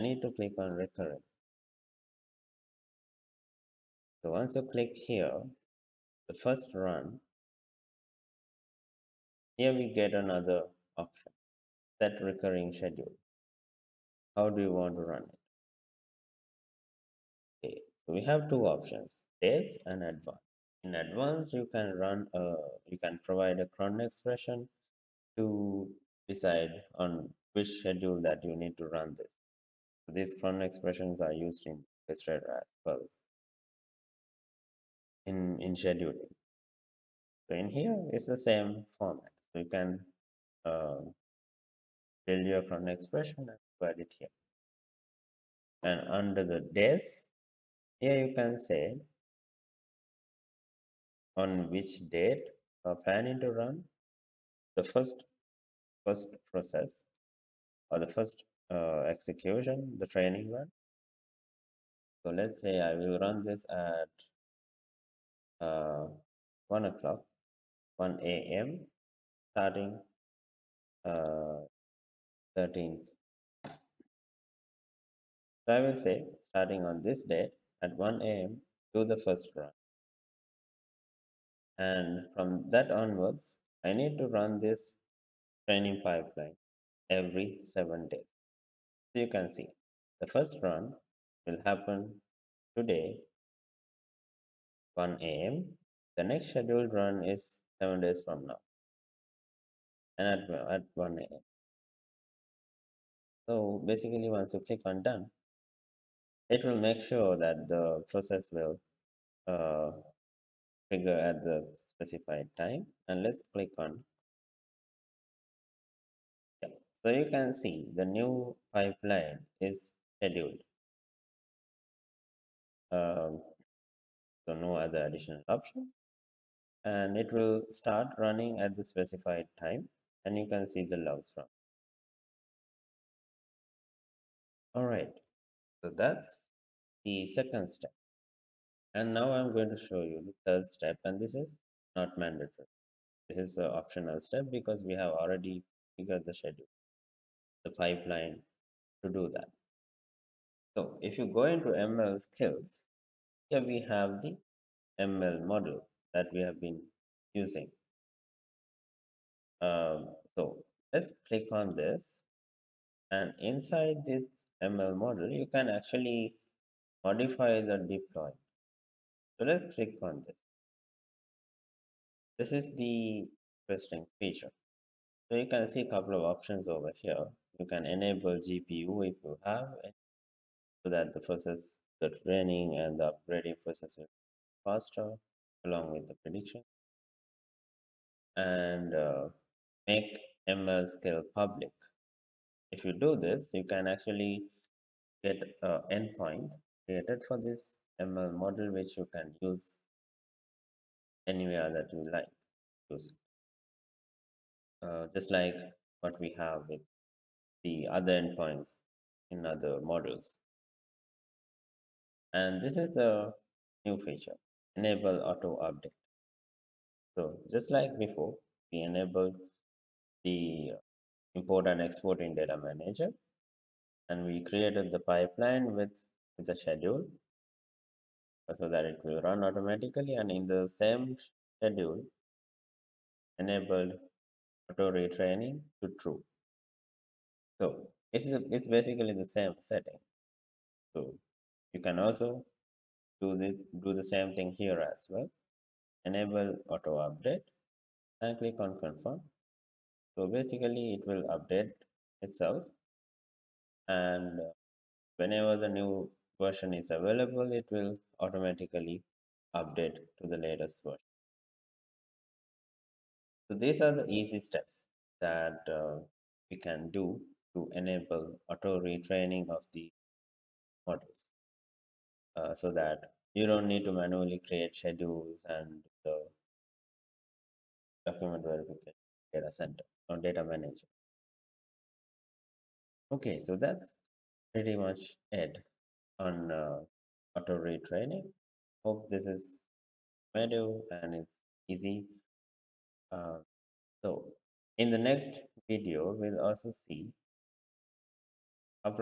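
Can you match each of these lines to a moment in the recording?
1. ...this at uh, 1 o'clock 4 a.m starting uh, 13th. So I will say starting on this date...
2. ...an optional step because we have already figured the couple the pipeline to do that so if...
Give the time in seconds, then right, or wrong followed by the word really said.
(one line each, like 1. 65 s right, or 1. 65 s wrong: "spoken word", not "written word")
1. 63 s wrong: "1", not "4"
2. 143 s wrong: "schedule", not "couple".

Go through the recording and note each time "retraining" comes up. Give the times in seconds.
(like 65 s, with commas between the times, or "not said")
234 s, 268 s, 287 s.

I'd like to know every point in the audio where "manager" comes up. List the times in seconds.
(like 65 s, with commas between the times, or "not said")
222 s, 280 s.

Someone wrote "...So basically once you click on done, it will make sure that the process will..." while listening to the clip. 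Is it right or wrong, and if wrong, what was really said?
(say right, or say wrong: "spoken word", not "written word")
right.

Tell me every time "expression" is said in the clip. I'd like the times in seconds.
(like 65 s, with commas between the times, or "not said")
23 s, 30 s, 42 s.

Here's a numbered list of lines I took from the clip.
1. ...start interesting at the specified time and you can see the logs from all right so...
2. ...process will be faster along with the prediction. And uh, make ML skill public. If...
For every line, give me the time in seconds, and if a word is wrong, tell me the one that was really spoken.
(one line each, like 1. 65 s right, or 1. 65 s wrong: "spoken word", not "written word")
1. 127 s wrong: "running", not "interesting"
2. 183 s right.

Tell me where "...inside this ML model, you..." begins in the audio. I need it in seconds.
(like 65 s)
163 s.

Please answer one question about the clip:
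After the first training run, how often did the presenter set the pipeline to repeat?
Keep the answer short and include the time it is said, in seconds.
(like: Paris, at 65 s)
Every 7 days, at 87 s.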